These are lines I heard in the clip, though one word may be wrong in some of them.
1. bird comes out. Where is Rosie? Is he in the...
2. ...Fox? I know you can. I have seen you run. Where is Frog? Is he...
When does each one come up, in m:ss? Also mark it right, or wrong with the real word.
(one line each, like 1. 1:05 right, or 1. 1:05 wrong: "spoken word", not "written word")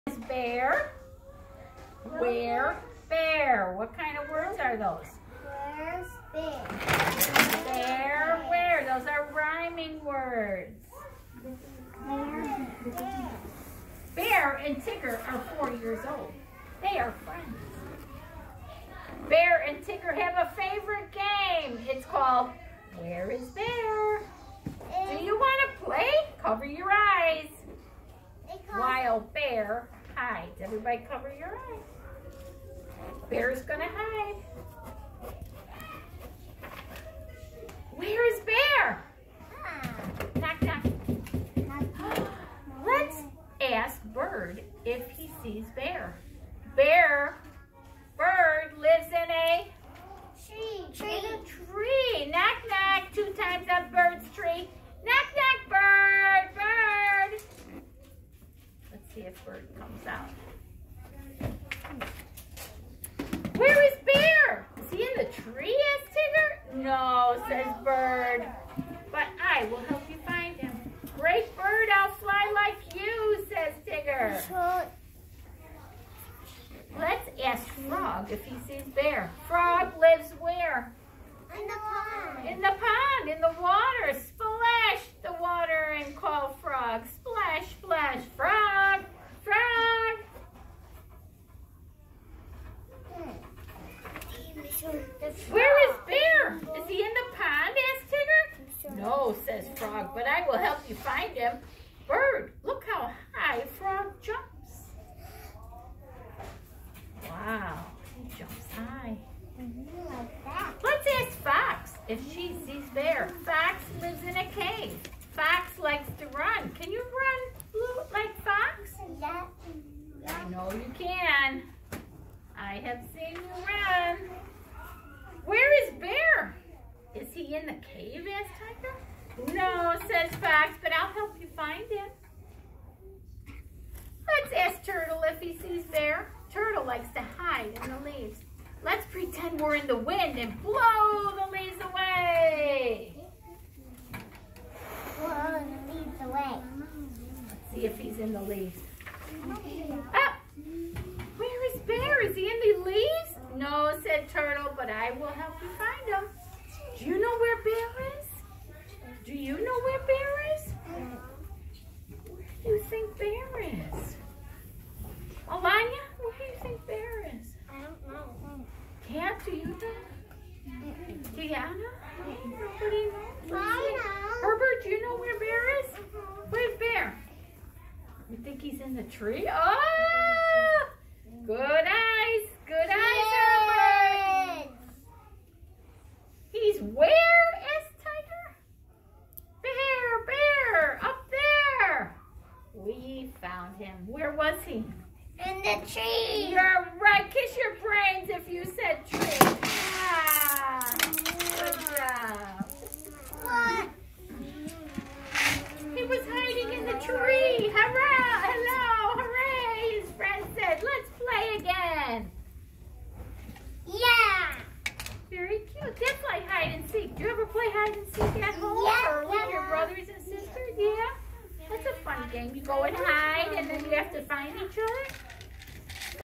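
1. 0:59 wrong: "Bear", not "Rosie"
2. 1:58 wrong: "Bear", not "Frog".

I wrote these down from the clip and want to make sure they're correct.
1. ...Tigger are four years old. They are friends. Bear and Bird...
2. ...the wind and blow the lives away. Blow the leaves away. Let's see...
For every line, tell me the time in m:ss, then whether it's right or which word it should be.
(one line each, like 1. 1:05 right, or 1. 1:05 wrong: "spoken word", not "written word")
1. 0:14 wrong: "Tigger", not "Bird"
2. 2:19 wrong: "leaves", not "lives".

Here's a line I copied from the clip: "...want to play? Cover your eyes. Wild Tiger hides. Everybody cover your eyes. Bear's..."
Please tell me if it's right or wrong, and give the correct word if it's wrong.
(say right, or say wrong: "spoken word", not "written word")
wrong: "Bear", not "Tiger".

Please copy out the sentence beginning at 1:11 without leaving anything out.
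Great bird, I'll fly like you, says Tigger.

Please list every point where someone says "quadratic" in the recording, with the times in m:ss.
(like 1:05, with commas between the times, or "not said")
not said.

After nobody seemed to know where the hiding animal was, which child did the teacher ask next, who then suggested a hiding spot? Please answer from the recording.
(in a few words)
Herbert.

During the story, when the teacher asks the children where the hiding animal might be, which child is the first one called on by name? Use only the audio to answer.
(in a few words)
Alanya.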